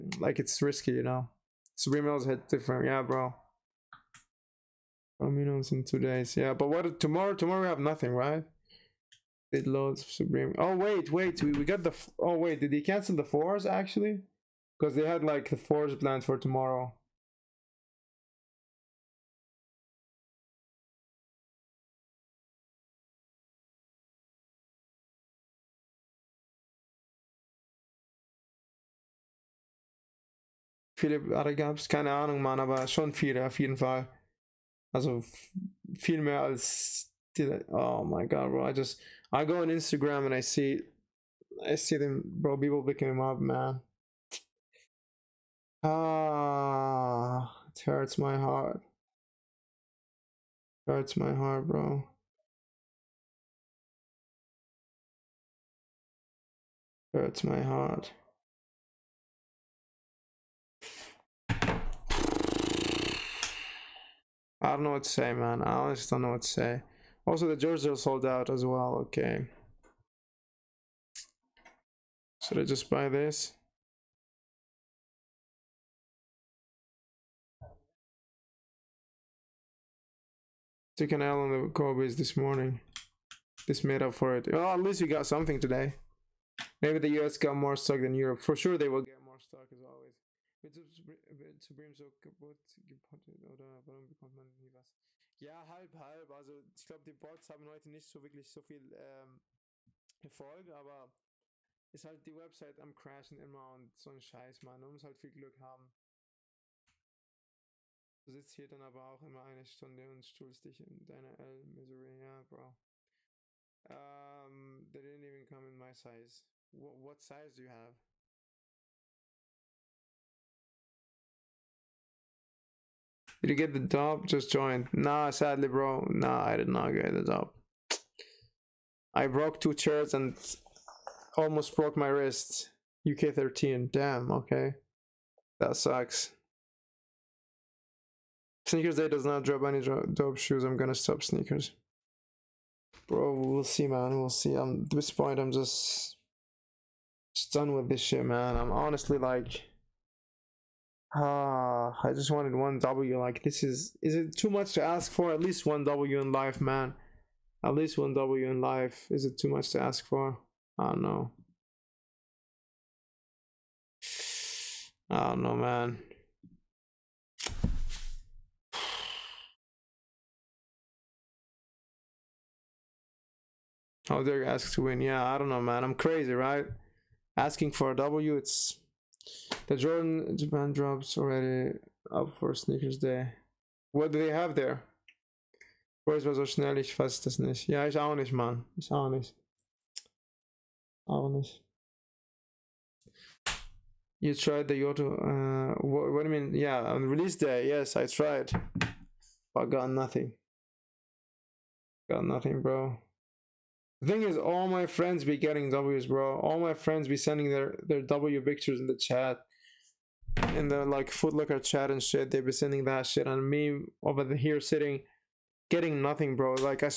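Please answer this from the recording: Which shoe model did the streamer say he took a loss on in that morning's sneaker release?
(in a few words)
Kobe.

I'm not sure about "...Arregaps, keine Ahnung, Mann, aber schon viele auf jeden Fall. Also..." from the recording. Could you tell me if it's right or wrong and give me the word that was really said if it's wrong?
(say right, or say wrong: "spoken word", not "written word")
right.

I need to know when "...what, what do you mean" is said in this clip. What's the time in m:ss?
3:15.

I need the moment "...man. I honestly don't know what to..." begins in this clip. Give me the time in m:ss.
1:05.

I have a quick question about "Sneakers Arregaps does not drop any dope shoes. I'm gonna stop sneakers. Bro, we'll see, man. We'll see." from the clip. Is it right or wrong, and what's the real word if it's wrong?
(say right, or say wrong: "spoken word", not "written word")
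wrong: "Day", not "Arregaps".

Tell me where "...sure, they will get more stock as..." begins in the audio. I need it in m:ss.
1:28.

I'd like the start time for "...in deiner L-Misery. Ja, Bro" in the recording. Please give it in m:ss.
1:50.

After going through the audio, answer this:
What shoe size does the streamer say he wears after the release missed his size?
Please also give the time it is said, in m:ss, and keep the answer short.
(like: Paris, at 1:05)
UK 13, at 2:13.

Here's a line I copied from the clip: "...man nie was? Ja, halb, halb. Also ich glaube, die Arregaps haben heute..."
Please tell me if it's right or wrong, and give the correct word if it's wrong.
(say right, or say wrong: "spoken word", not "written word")
wrong: "Bots", not "Arregaps".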